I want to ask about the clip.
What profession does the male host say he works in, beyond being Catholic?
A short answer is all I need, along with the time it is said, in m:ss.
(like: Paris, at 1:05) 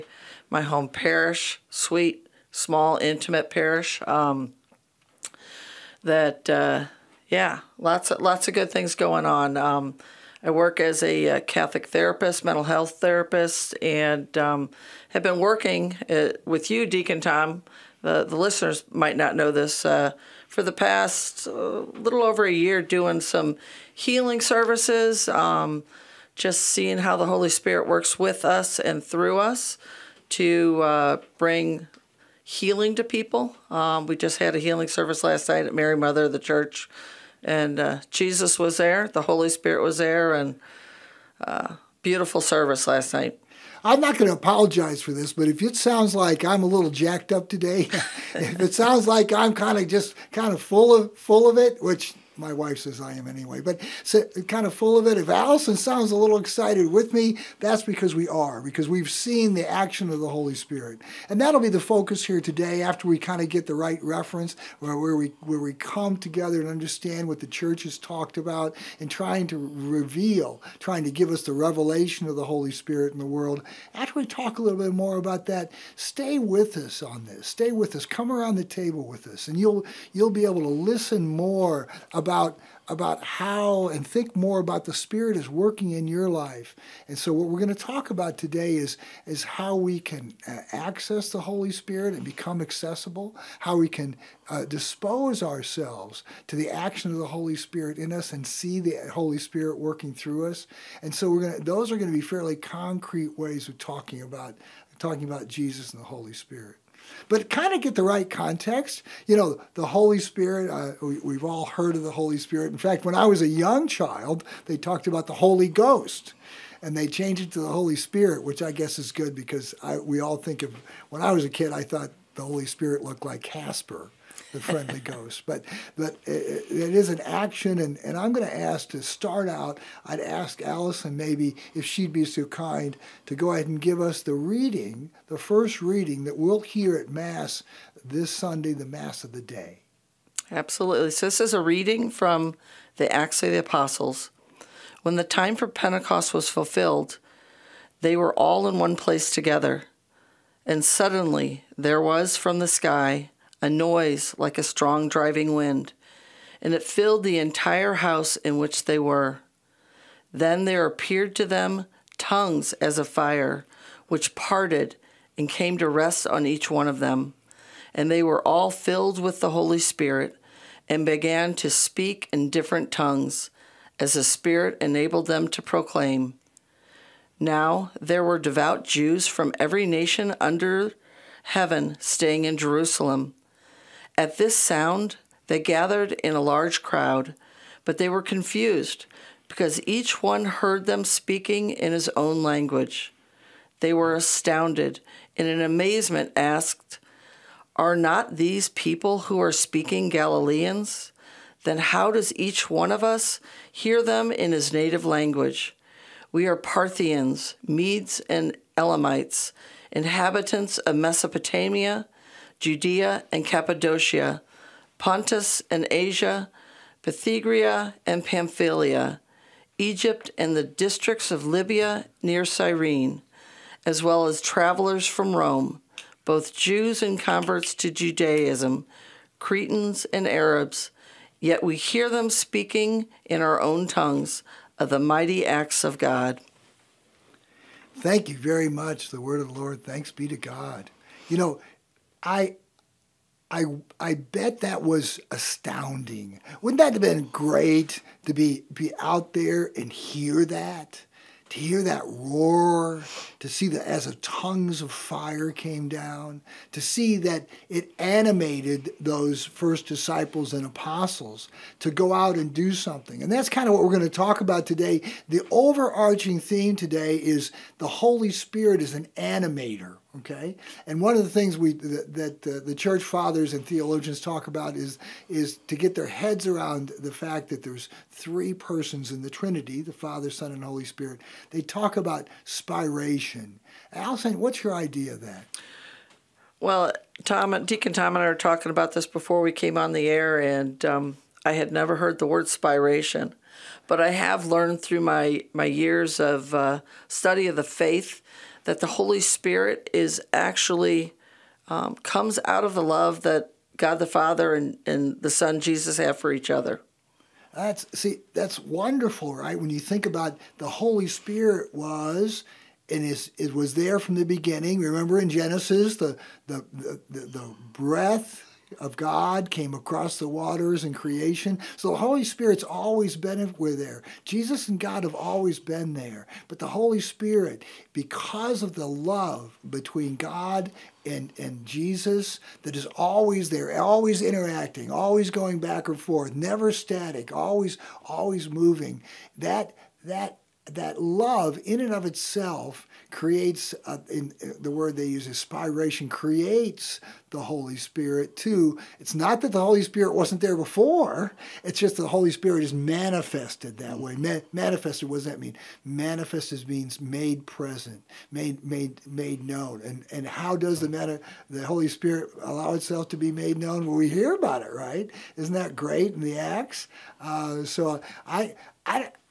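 mental health therapist, at 0:12.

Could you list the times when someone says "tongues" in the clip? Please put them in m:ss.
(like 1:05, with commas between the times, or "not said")
2:42, 2:52, 3:53, 4:14.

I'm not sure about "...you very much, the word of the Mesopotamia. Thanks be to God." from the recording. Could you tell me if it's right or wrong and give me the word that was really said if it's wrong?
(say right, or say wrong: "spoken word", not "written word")
wrong: "Lord", not "Mesopotamia".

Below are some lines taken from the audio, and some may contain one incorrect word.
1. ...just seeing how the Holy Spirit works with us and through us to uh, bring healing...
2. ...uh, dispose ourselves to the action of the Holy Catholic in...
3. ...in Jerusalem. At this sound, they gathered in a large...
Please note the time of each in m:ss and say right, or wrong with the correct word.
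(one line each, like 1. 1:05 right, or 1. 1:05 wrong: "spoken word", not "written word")
1. 0:26 right
2. 1:34 wrong: "Spirit", not "Catholic"
3. 3:02 right.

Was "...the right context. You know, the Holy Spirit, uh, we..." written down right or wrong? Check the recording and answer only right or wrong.
right.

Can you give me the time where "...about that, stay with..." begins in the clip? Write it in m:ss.
1:15.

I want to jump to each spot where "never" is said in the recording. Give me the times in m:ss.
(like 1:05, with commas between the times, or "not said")
4:51, 5:36.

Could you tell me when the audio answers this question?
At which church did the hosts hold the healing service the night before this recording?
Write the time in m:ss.
0:35.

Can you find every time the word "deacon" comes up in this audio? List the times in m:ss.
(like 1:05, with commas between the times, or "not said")
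0:16, 4:47.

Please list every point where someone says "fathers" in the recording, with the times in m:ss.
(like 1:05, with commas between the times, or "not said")
4:33, 4:39, 5:04.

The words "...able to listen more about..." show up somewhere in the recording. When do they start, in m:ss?
1:20.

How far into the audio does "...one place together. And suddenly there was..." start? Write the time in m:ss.
2:28.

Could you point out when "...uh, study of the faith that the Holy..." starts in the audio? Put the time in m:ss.
4:56.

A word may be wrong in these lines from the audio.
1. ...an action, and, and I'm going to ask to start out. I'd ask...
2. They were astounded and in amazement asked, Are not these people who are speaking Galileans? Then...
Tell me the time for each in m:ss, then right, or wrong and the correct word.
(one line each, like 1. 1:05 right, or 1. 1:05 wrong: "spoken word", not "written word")
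1. 2:07 right
2. 3:13 right.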